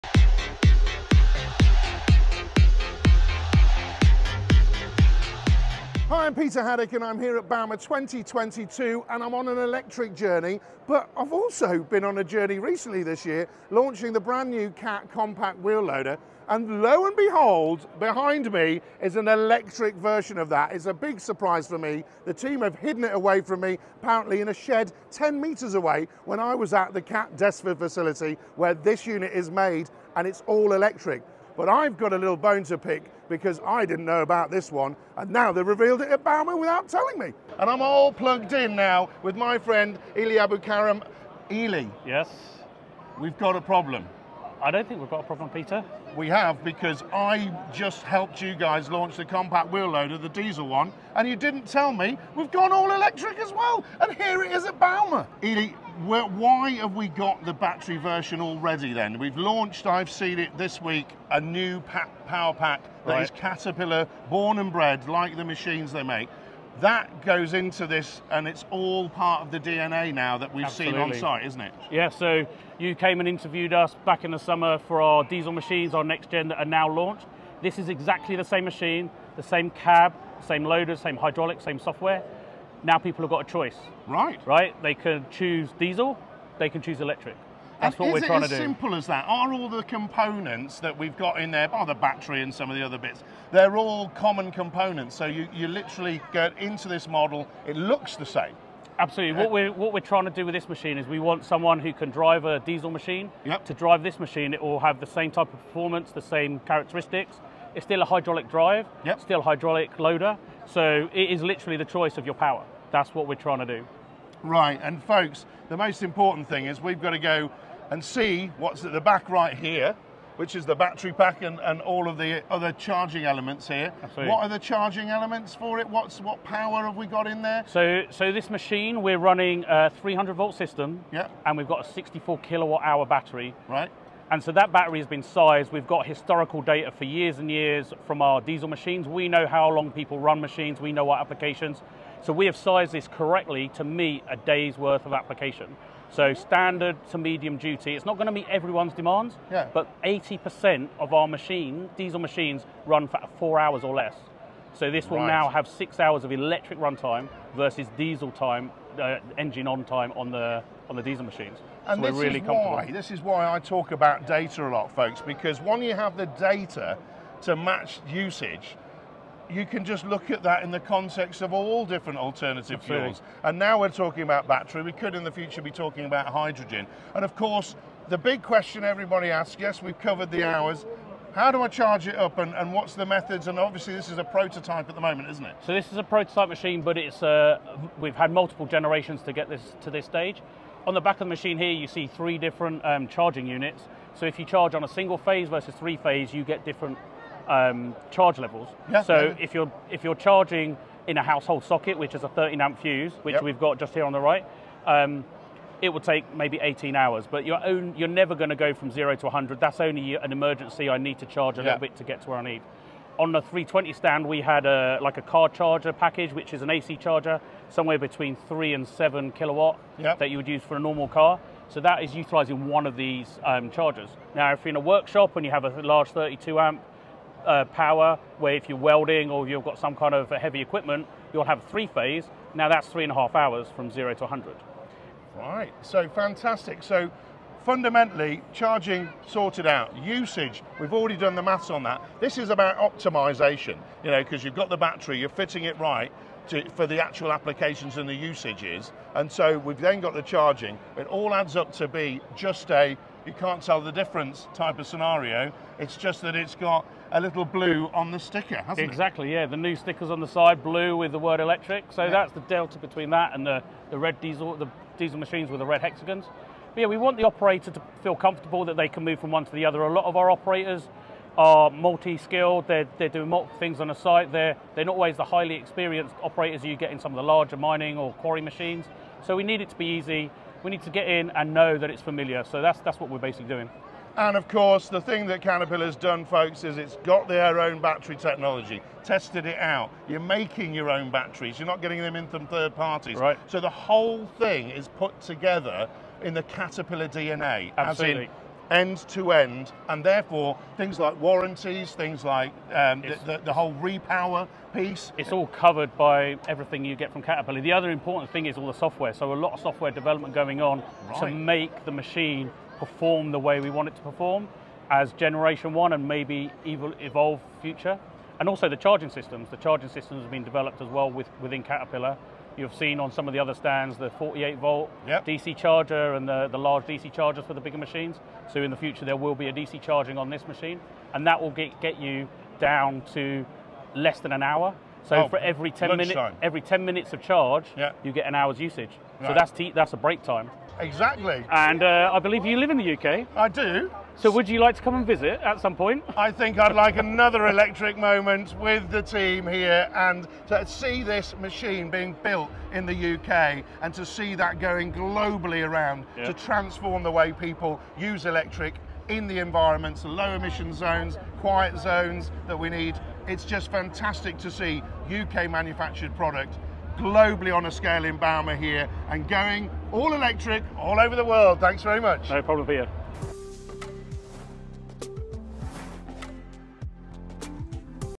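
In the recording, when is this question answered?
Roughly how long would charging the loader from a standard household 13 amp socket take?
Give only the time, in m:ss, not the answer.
3:26.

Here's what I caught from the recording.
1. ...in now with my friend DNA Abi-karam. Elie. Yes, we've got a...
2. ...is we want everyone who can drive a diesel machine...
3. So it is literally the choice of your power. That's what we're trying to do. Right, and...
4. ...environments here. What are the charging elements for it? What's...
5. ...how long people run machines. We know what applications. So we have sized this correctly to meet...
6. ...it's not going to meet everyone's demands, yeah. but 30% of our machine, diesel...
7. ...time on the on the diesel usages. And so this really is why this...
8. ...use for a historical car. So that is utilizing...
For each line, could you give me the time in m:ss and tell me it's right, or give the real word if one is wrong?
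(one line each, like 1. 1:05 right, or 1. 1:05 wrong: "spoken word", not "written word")
1. 0:38 wrong: "Elie", not "DNA"
2. 1:40 wrong: "someone", not "everyone"
3. 1:50 right
4. 2:03 wrong: "elements", not "environments"
5. 2:19 right
6. 2:27 wrong: "80", not "30"
7. 2:39 wrong: "machines", not "usages"
8. 3:40 wrong: "normal", not "historical".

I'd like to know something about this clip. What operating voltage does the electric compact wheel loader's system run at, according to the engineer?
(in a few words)
300 volts.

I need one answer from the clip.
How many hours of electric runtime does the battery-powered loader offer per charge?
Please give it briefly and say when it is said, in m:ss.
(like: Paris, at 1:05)
6 hours, at 2:35.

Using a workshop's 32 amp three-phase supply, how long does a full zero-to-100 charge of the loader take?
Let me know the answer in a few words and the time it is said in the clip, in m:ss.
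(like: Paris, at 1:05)
3.5 hours, at 3:52.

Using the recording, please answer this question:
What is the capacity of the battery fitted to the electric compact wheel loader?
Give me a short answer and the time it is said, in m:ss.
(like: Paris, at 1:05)
64 kWh, at 2:11.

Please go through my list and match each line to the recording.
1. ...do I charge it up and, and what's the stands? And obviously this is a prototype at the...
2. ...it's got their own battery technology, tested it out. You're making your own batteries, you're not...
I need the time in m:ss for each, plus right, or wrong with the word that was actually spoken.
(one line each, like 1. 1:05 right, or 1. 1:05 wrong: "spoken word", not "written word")
1. 3:01 wrong: "methods", not "stands"
2. 4:46 right.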